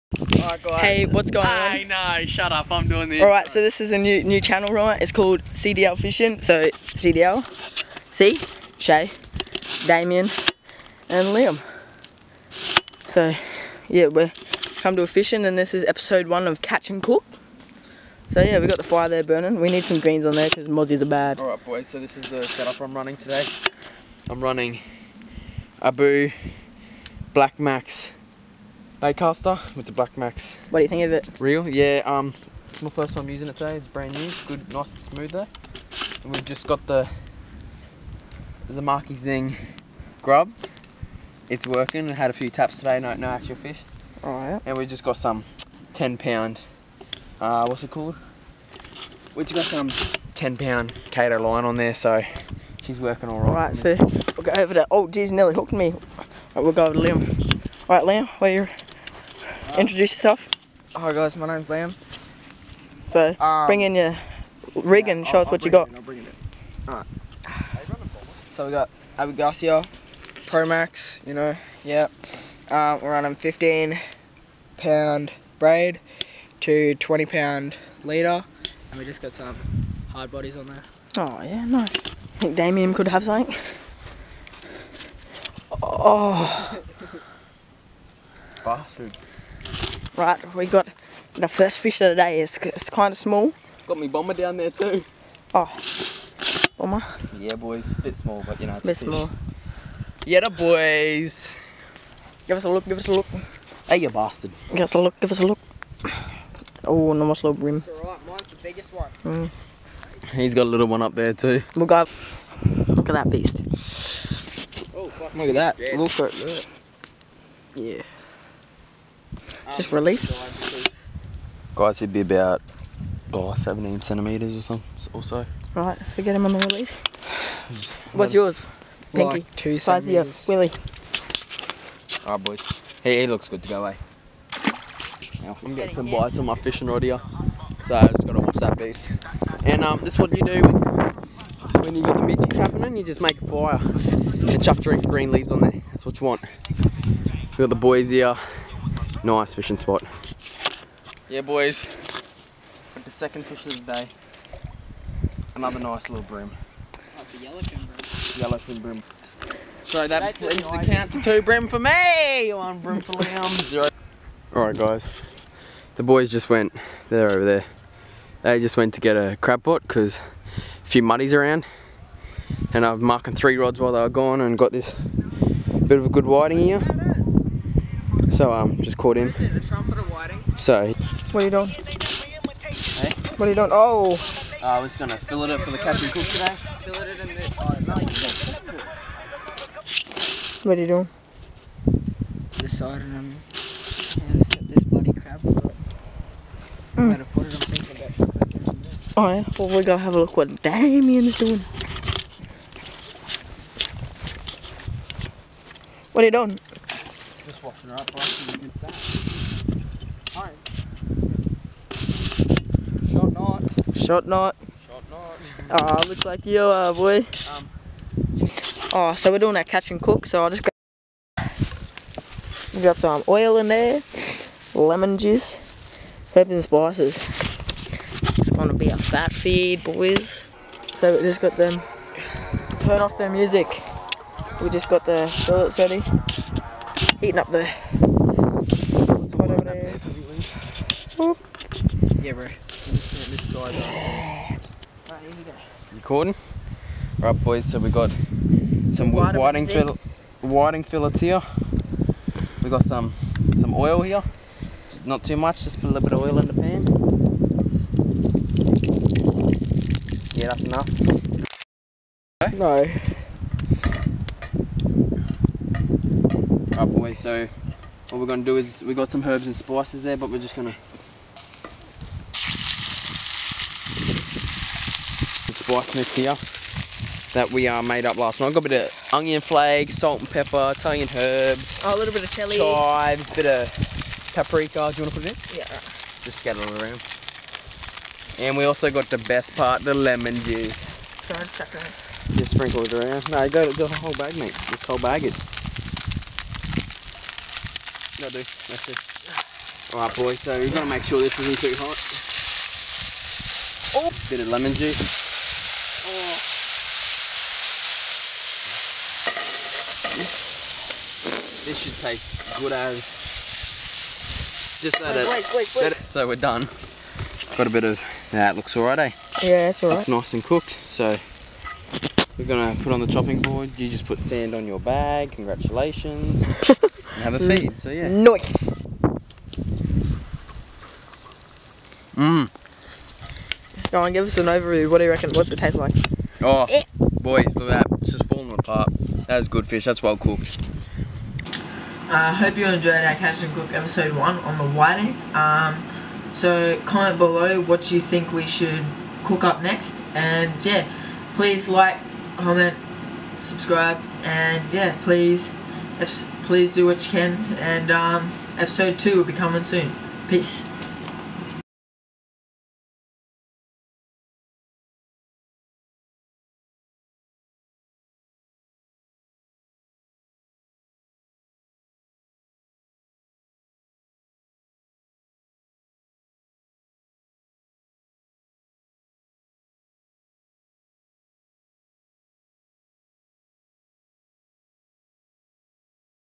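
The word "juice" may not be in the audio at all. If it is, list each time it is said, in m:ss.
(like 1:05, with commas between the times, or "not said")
3:45, 4:50, 5:04.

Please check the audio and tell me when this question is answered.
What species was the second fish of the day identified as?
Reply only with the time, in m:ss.
2:37.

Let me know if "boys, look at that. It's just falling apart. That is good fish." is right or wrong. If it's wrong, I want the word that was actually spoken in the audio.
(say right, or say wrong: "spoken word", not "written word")
right.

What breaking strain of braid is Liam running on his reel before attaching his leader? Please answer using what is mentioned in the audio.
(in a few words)
15 pound.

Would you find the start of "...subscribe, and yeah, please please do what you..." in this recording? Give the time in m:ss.
5:53.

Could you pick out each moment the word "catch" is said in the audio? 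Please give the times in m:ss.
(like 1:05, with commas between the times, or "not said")
0:16, 3:39, 5:43.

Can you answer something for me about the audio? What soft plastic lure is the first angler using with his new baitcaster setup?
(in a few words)
Marky Zing grub.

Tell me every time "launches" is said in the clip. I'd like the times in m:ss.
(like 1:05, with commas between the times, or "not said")
not said.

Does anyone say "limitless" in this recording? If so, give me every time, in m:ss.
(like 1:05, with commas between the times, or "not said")
not said.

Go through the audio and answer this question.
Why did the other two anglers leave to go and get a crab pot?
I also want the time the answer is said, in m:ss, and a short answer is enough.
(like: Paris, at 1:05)
A few muddies around, at 2:50.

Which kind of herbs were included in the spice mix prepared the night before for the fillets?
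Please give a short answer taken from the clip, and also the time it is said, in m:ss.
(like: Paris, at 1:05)
Italian herbs, at 4:40.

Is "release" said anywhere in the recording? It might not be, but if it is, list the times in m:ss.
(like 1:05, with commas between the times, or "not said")
1:59, 2:06.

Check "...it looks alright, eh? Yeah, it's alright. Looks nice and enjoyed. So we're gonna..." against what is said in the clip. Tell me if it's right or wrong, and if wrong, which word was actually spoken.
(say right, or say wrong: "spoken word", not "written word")
wrong: "cooked", not "enjoyed".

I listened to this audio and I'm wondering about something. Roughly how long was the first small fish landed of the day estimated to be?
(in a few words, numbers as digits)
17 centimetres.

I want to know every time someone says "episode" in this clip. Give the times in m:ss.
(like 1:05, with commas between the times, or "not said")
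0:15, 5:43, 5:58.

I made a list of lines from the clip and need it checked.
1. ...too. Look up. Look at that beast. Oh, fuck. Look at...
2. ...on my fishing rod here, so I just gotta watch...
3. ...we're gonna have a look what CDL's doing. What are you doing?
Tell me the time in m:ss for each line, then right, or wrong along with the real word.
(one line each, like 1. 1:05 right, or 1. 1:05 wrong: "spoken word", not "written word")
1. 1:51 right
2. 2:16 right
3. 3:19 wrong: "Damien", not "CDL".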